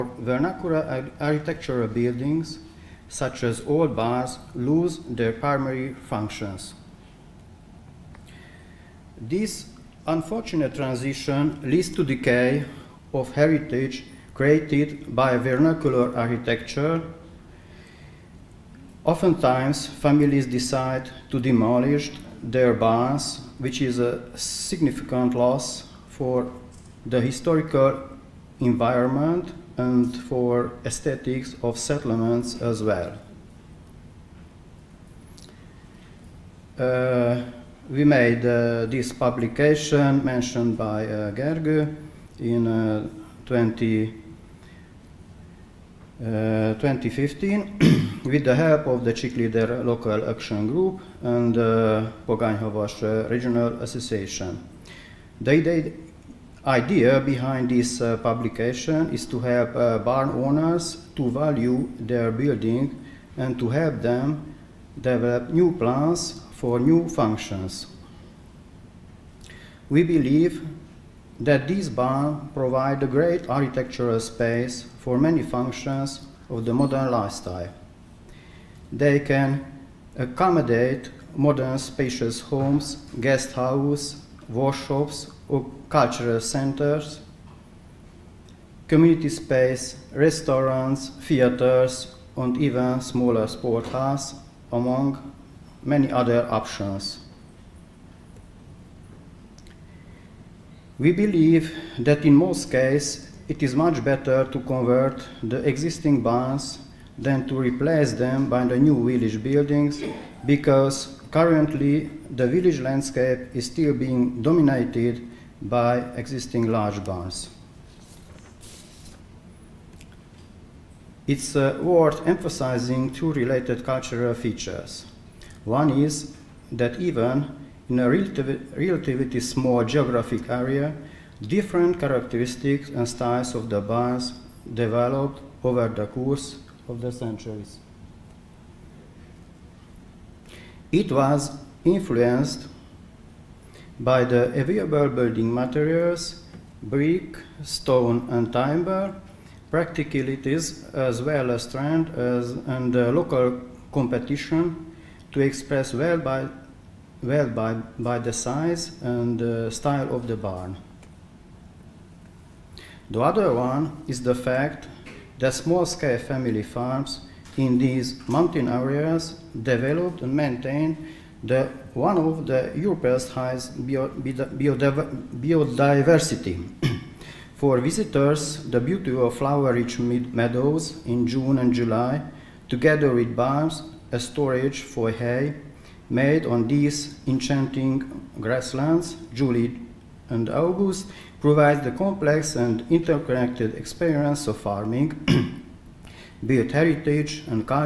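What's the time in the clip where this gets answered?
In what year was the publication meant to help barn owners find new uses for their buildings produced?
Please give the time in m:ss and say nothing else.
0:46.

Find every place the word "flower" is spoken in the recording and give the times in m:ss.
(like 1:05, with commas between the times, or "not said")
2:59.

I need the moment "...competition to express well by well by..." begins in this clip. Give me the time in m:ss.
2:33.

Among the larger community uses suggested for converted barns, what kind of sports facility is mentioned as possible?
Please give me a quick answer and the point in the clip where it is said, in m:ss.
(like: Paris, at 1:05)
smaller sport halls, at 1:32.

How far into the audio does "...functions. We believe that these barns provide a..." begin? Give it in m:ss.
1:07.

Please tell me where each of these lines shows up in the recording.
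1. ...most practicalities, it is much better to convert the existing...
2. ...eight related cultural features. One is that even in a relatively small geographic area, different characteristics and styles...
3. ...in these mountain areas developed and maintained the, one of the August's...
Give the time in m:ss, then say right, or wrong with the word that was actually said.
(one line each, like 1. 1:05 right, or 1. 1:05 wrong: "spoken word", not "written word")
1. 1:42 wrong: "cases", not "practicalities"
2. 2:03 wrong: "two", not "eight"
3. 2:47 wrong: "Europe", not "August".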